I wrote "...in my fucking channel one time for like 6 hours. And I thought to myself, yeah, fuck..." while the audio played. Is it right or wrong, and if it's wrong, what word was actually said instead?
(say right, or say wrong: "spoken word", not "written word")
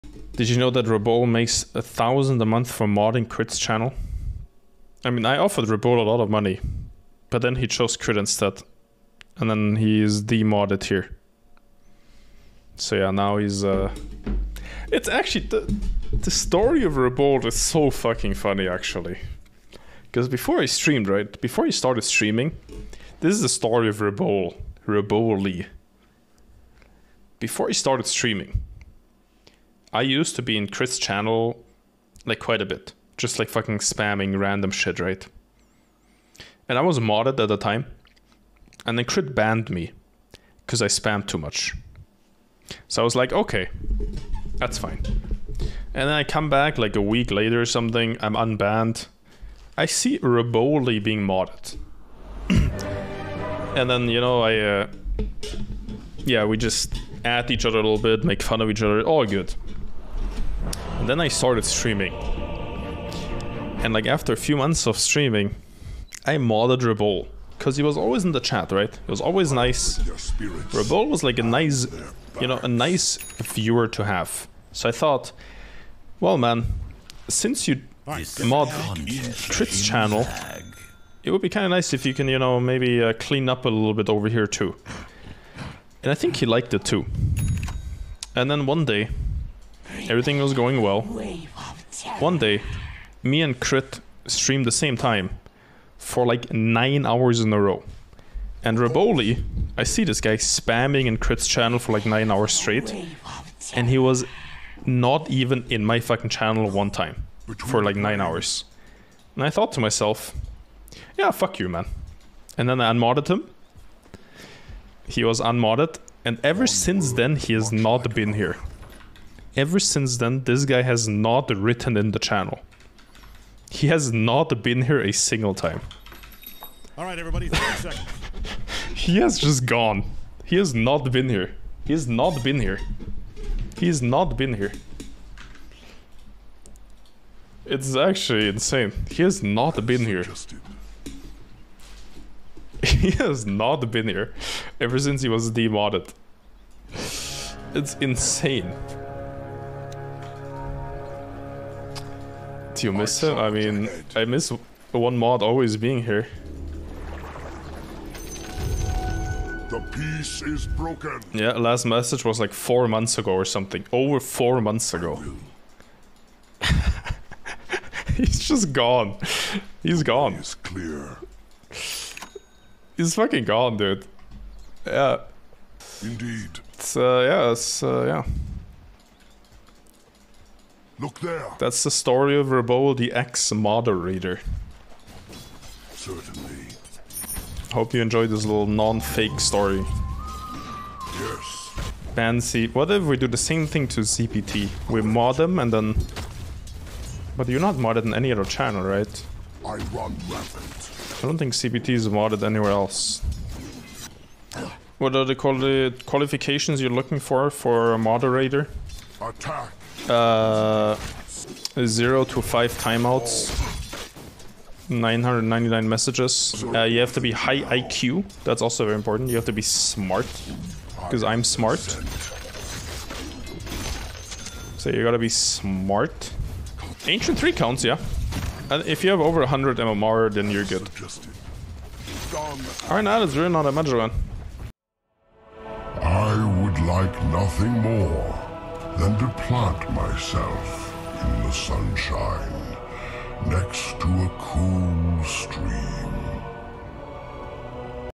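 wrong: "9", not "6".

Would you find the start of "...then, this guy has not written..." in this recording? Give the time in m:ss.
2:00.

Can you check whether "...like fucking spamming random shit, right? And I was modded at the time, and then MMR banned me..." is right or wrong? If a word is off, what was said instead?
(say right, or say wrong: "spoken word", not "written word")
wrong: "Crit", not "MMR".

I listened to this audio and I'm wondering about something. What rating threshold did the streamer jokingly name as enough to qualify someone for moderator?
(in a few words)
100 MMR.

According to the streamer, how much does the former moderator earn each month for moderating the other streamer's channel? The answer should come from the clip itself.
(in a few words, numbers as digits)
1,000.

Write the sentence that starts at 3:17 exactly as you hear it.
But you're not modded in any other channel, right?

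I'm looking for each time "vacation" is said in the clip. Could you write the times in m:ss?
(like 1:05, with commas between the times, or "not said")
not said.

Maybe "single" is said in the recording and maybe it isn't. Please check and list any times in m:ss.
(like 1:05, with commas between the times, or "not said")
2:05.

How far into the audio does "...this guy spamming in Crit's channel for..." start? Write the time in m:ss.
1:40.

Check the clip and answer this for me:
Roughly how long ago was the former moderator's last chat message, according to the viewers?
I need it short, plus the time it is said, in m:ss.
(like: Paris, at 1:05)
Over 4 months, at 2:43.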